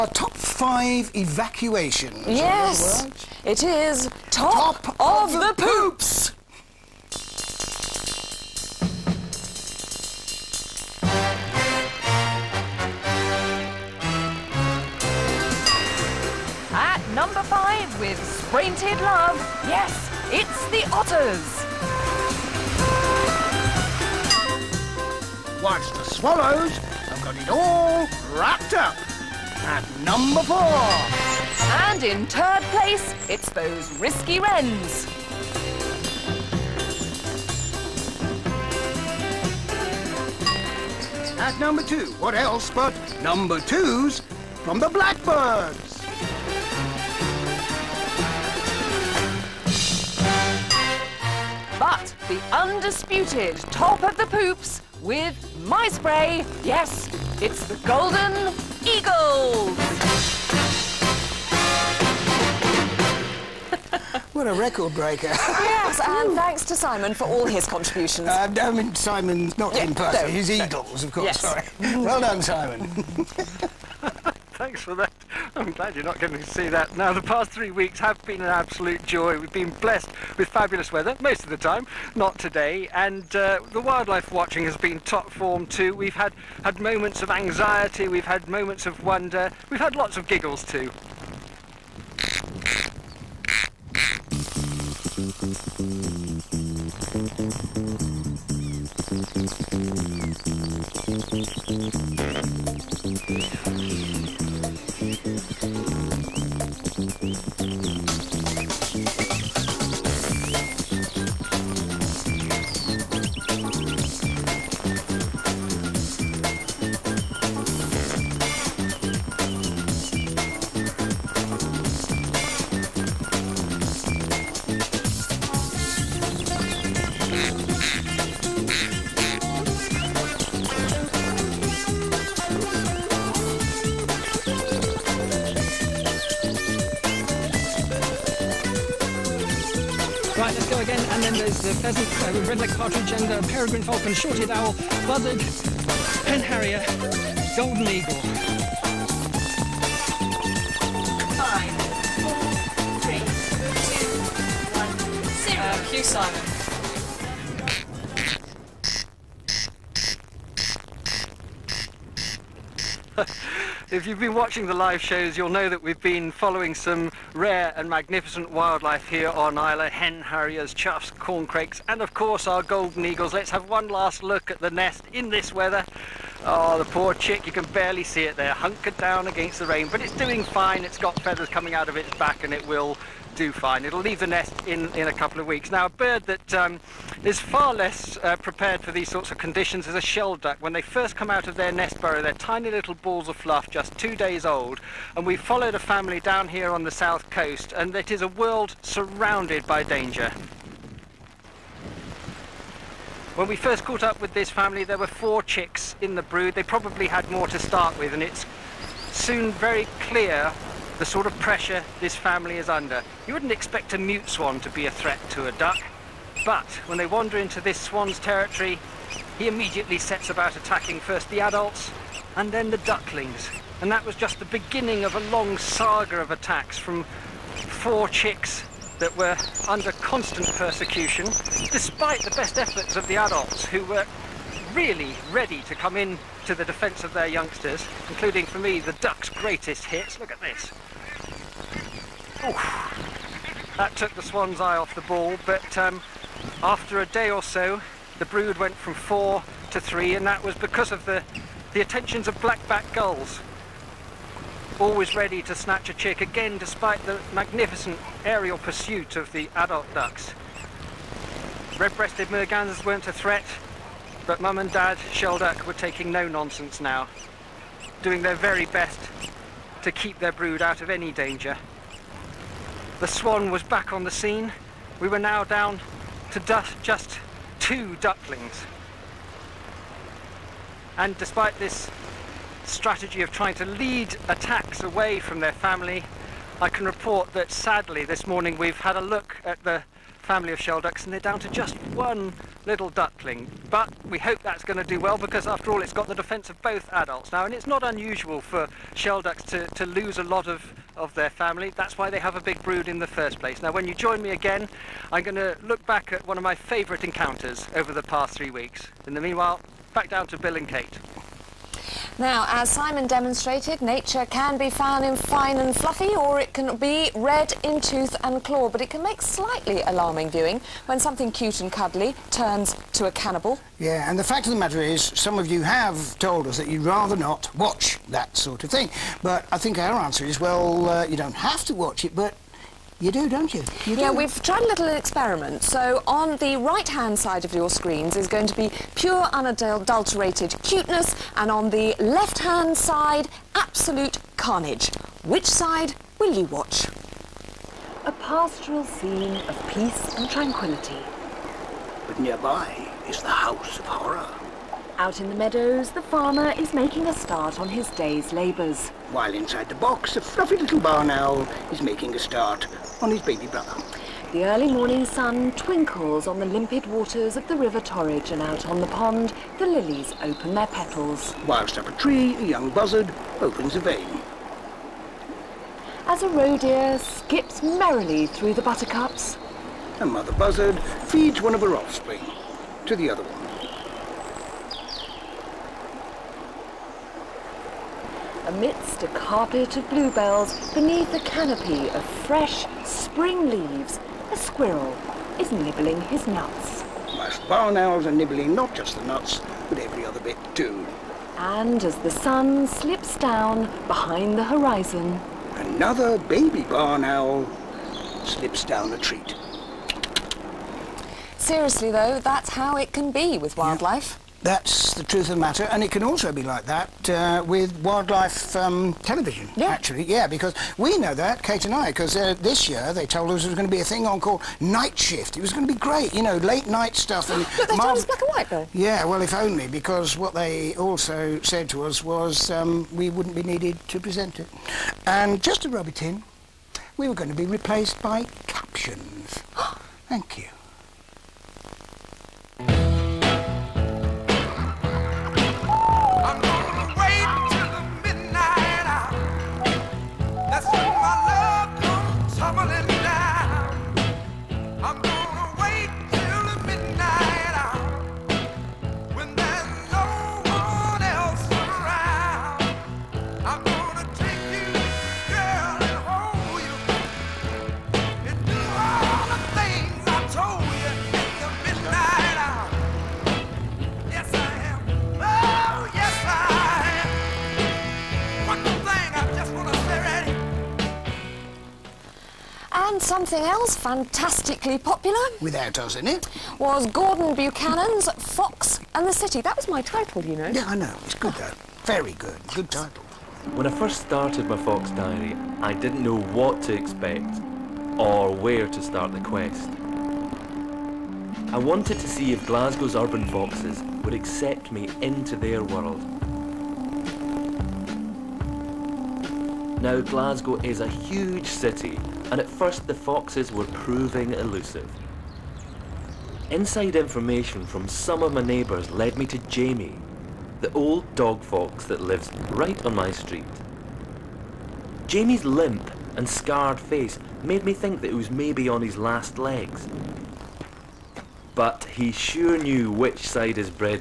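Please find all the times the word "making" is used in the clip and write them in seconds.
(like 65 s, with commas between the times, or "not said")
356 s, 361 s.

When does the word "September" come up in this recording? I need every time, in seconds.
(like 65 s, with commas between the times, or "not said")
not said.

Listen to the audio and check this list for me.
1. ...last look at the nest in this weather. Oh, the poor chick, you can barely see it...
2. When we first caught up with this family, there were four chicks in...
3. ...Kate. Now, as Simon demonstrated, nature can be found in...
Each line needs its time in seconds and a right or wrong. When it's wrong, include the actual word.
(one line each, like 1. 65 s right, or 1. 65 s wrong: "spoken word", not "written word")
1. 173 s right
2. 203 s right
3. 310 s right.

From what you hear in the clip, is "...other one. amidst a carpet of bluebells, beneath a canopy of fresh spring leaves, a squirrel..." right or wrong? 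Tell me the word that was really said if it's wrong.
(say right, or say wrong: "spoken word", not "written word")
right.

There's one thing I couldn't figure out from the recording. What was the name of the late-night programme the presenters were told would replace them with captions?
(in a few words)
Night Shift.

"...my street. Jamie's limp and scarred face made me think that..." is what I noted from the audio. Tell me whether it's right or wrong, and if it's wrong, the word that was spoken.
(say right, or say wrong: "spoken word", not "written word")
right.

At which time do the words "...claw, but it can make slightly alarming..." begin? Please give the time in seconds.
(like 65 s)
318 s.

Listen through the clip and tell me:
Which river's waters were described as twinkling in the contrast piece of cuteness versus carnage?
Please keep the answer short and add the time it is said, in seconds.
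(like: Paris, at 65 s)
River Torridge, at 367 s.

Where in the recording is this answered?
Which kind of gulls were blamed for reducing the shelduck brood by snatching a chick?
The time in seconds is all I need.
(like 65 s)
252 s.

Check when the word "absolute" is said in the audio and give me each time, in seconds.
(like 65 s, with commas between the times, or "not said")
78 s, 343 s.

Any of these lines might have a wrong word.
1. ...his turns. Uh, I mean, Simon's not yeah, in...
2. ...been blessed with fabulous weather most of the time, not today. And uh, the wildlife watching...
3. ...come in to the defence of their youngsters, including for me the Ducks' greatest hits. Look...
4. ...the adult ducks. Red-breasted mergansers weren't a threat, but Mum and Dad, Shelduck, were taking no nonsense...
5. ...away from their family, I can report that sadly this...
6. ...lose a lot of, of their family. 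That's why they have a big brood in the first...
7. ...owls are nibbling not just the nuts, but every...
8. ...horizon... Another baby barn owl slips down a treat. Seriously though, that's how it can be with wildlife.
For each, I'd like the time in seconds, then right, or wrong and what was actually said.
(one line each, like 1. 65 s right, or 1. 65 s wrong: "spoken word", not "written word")
1. 67 s wrong: "contributions", not "turns"
2. 79 s right
3. 235 s right
4. 259 s right
5. 284 s right
6. 299 s right
7. 397 s right
8. 404 s right.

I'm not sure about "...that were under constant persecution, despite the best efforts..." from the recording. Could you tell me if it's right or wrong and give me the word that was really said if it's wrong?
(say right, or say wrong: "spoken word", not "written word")
right.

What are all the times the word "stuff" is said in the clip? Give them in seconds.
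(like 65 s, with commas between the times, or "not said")
426 s.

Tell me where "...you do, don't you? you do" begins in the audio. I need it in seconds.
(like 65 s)
333 s.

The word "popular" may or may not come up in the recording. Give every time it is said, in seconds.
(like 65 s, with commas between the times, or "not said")
484 s.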